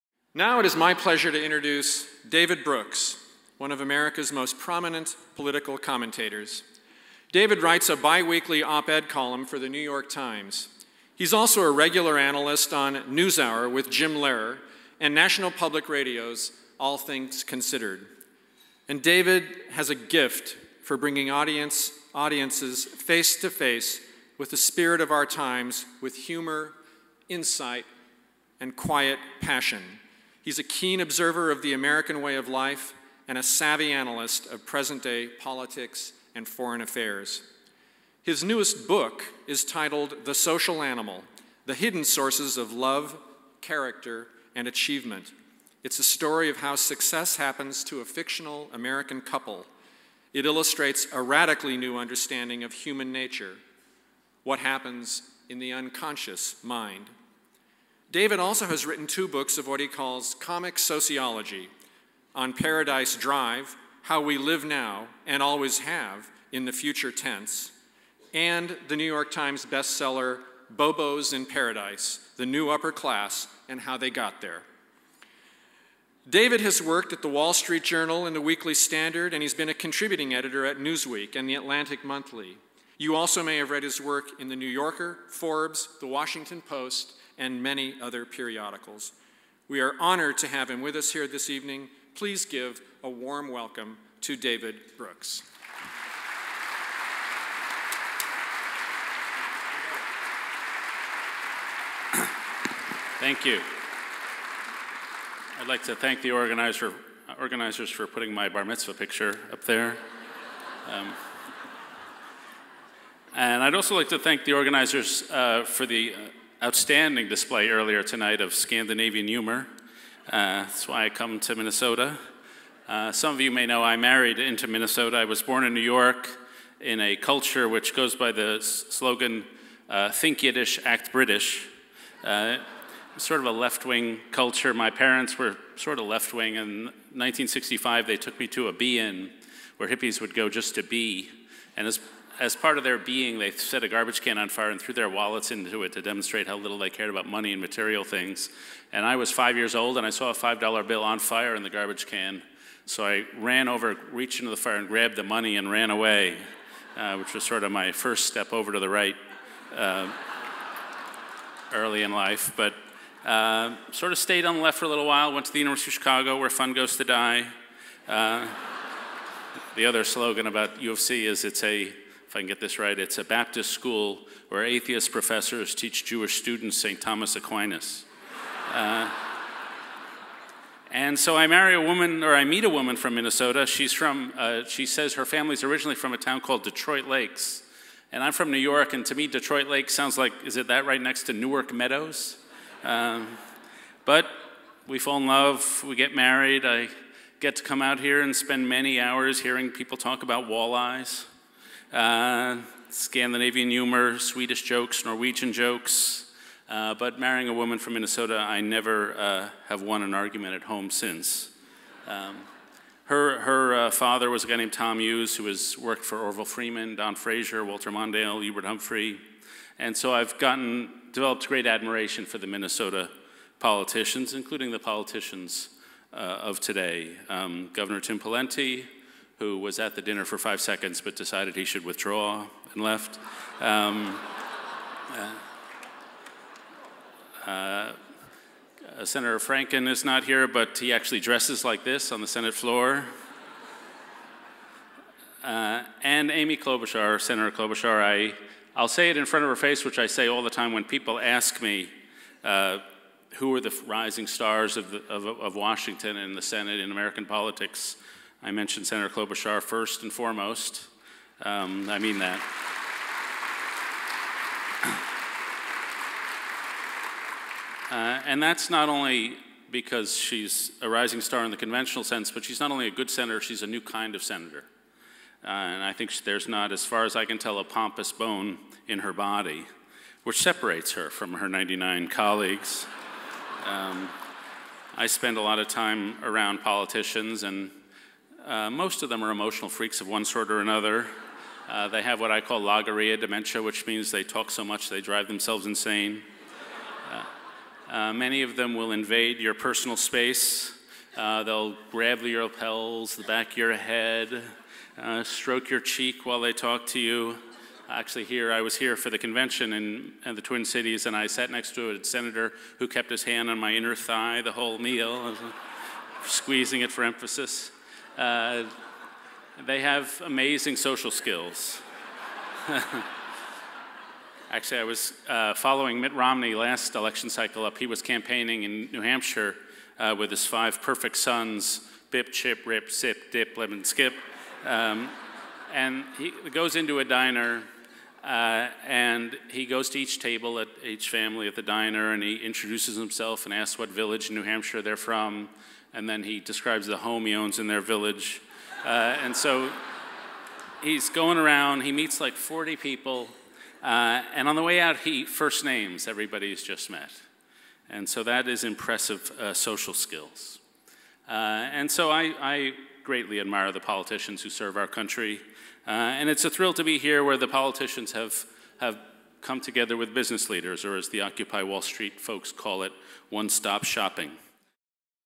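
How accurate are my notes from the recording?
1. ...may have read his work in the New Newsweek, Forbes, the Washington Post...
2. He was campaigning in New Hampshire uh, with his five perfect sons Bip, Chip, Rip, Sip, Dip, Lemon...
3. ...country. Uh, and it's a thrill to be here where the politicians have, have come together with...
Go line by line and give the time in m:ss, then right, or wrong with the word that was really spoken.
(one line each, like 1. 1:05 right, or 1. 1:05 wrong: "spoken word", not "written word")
1. 1:23 wrong: "Yorker", not "Newsweek"
2. 5:27 right
3. 6:04 right.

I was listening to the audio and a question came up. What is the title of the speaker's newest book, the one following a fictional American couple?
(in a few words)
The Social Animal.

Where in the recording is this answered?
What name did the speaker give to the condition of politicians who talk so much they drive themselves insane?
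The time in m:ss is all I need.
4:52.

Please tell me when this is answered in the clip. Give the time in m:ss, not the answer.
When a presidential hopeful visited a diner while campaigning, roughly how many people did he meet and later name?
5:52.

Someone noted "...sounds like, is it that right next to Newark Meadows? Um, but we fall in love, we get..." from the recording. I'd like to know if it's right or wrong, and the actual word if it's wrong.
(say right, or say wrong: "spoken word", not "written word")
right.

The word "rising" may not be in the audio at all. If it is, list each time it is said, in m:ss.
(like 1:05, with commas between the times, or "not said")
4:13, 4:30.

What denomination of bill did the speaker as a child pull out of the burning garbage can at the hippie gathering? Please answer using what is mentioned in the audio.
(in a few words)
$5.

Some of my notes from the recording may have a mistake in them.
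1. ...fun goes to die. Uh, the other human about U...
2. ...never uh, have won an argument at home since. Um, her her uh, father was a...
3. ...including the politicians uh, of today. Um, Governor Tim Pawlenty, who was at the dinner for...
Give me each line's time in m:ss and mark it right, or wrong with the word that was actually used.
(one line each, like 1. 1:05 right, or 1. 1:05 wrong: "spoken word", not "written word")
1. 2:46 wrong: "slogan", not "human"
2. 3:28 right
3. 3:44 right.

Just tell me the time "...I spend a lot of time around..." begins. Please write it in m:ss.
4:44.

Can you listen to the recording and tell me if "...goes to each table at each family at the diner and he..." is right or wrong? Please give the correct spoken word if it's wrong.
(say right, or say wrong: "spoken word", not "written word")
right.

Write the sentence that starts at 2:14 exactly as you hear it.
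My parents were sort of left wing.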